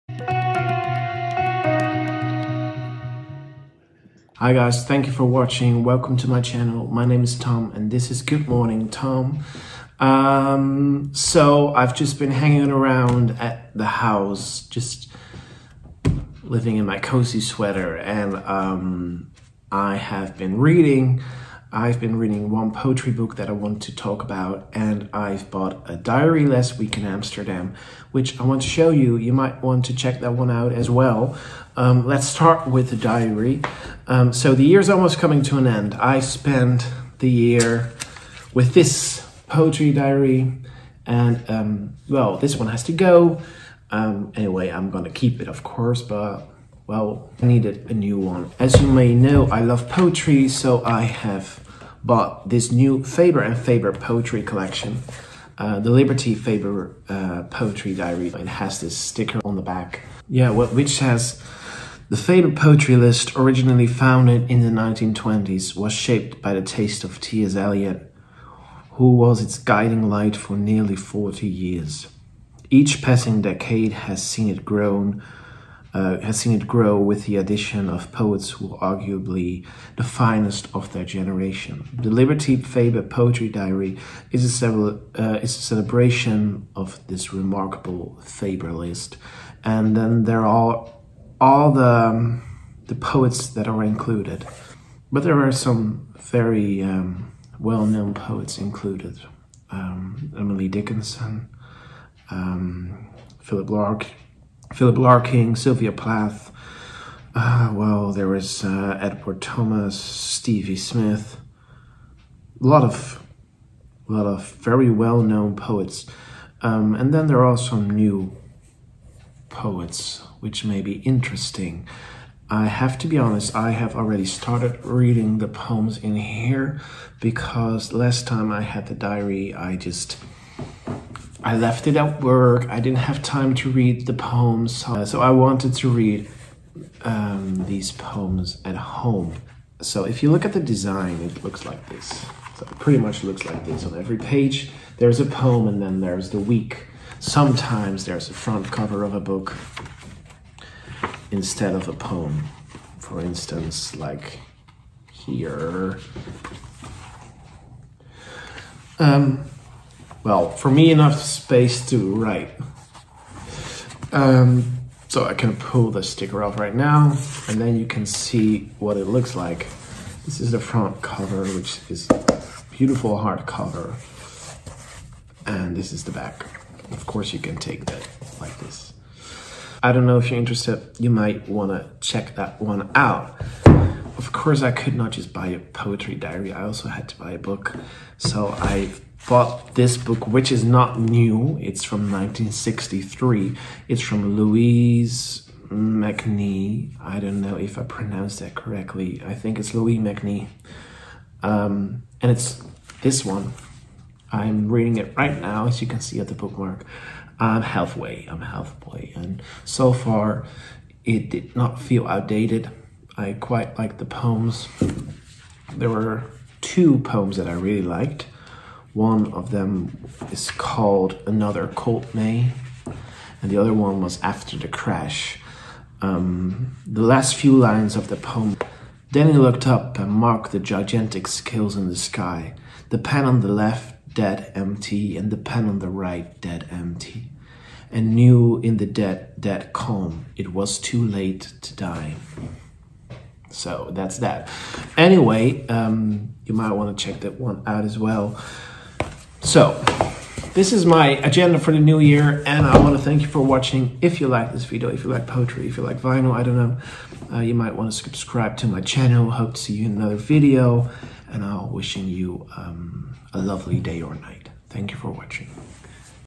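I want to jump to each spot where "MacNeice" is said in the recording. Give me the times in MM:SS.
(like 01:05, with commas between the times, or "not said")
03:15, 03:19.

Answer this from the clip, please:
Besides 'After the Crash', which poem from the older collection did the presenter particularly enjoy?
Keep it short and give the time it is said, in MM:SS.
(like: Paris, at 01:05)
Another Cold May, at 03:41.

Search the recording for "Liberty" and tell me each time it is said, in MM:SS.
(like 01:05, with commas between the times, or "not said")
00:55, 01:22.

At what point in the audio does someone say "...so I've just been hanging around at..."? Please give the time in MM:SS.
00:11.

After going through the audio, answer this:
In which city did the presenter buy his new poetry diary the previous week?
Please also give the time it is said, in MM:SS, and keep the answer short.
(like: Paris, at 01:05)
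Amsterdam, at 00:27.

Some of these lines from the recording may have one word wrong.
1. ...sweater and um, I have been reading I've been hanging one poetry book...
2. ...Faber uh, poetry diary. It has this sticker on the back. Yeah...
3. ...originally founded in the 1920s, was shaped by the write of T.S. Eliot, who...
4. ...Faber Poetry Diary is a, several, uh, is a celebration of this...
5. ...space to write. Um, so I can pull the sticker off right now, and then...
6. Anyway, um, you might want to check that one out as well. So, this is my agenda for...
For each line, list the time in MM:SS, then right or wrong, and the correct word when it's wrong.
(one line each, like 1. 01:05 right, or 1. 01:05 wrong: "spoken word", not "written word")
1. 00:17 wrong: "reading", not "hanging"
2. 00:56 right
3. 01:03 wrong: "taste", not "write"
4. 01:22 right
5. 02:41 right
6. 04:04 right.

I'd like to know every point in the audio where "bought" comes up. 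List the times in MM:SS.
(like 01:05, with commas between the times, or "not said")
00:25, 00:52, 03:09.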